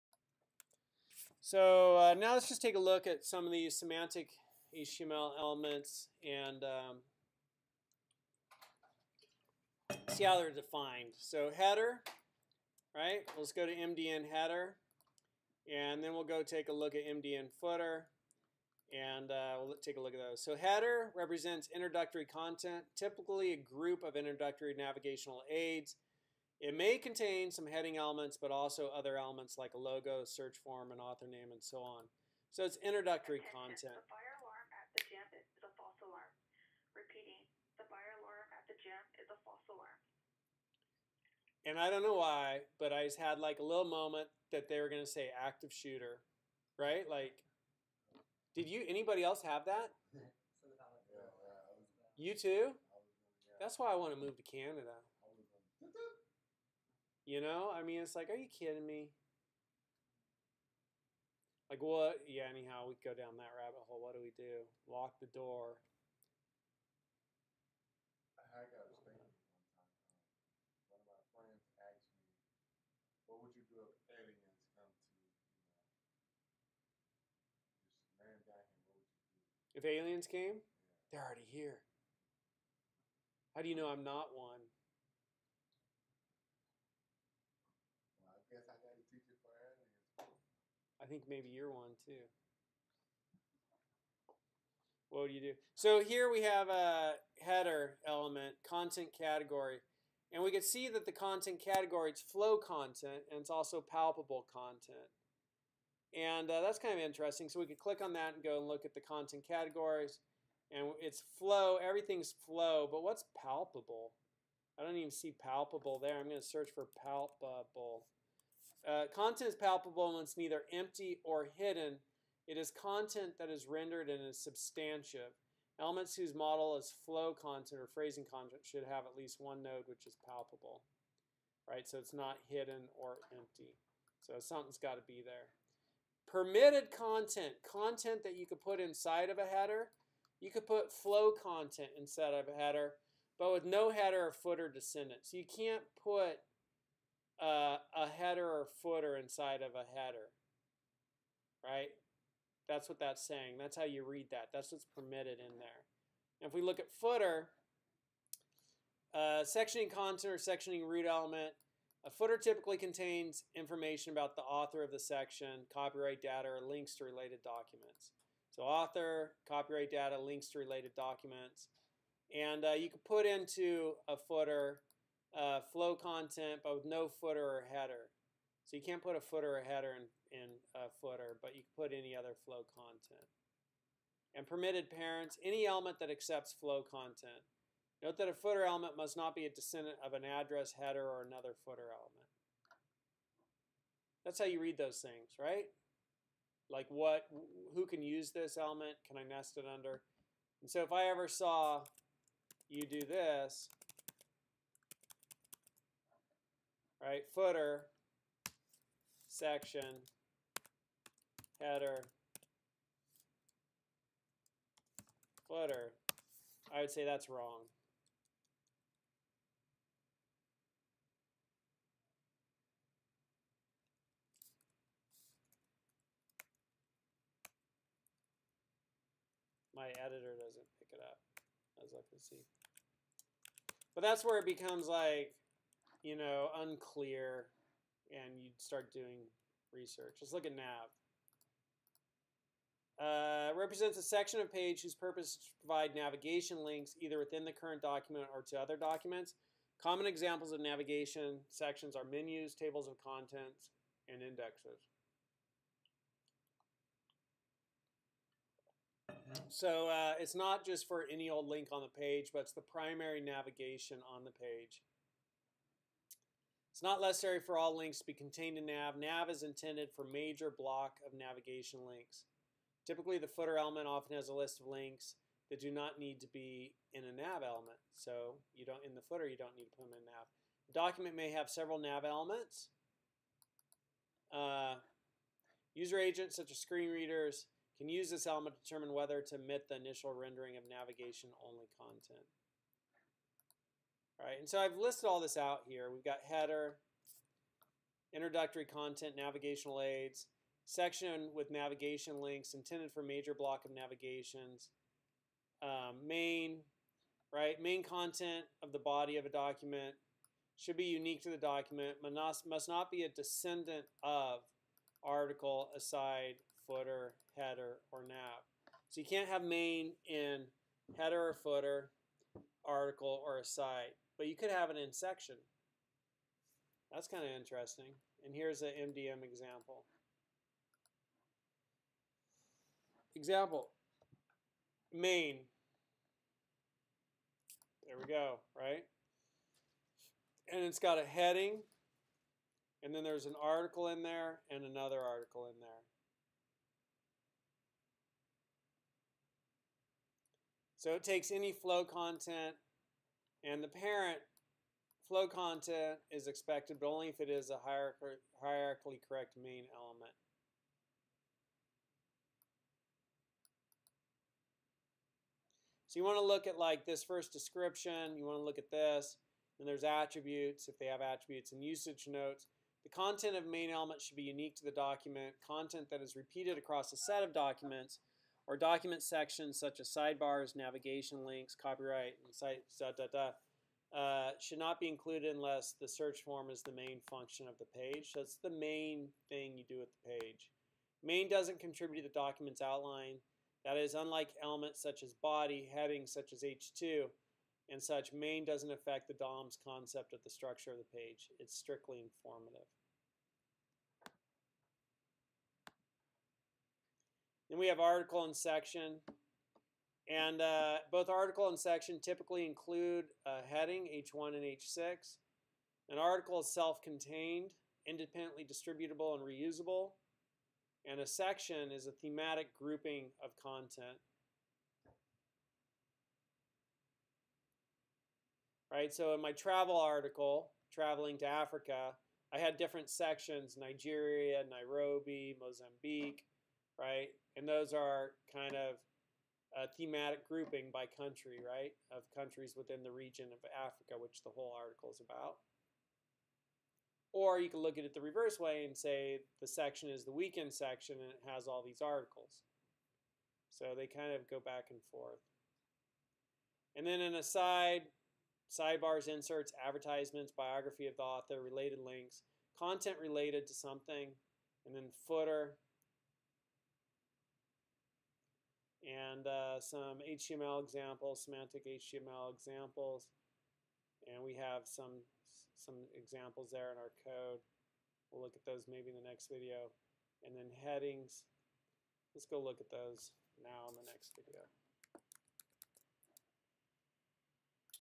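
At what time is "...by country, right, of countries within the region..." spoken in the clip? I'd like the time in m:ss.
7:20.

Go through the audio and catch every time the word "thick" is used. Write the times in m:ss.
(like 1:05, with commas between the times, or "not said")
not said.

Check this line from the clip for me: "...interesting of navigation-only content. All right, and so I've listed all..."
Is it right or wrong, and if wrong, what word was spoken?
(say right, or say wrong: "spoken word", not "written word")
wrong: "rendering", not "interesting".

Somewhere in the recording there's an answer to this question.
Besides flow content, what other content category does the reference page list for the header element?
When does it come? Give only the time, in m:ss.
1:43.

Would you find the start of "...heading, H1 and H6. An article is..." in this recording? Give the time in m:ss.
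6:53.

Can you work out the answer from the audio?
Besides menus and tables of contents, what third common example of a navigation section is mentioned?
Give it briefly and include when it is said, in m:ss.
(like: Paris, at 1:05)
Indexes, at 4:14.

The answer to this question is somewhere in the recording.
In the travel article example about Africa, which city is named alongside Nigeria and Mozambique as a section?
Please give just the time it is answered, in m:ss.
7:14.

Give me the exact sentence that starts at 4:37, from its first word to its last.
So you don't in the footer, you don't need to put them in nav.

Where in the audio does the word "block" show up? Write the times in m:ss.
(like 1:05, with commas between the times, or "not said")
4:30, 5:03.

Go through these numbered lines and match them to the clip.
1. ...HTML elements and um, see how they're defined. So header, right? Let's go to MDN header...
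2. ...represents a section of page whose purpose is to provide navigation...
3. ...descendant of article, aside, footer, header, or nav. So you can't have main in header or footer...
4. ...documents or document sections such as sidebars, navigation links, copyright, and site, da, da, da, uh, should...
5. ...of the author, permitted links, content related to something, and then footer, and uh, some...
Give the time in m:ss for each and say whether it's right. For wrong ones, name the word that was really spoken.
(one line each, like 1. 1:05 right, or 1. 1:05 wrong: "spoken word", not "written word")
1. 0:04 right
2. 4:03 right
3. 5:13 right
4. 6:17 right
5. 7:40 wrong: "related", not "permitted".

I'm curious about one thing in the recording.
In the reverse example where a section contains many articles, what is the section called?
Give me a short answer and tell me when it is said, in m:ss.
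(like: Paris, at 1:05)
The weekend section, at 7:30.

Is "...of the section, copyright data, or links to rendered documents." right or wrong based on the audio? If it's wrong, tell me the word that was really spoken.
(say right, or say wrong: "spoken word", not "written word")
wrong: "related", not "rendered".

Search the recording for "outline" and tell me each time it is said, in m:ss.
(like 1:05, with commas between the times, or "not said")
6:32.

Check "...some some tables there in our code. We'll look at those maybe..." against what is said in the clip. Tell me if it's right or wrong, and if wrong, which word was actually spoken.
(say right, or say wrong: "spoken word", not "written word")
wrong: "examples", not "tables".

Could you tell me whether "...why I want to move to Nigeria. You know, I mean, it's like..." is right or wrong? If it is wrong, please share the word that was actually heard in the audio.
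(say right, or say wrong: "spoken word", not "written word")
wrong: "Canada", not "Nigeria".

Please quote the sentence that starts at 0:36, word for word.
Repeating, the fire alarm at the gym is a false alarm.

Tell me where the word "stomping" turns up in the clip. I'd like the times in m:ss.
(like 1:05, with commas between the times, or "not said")
not said.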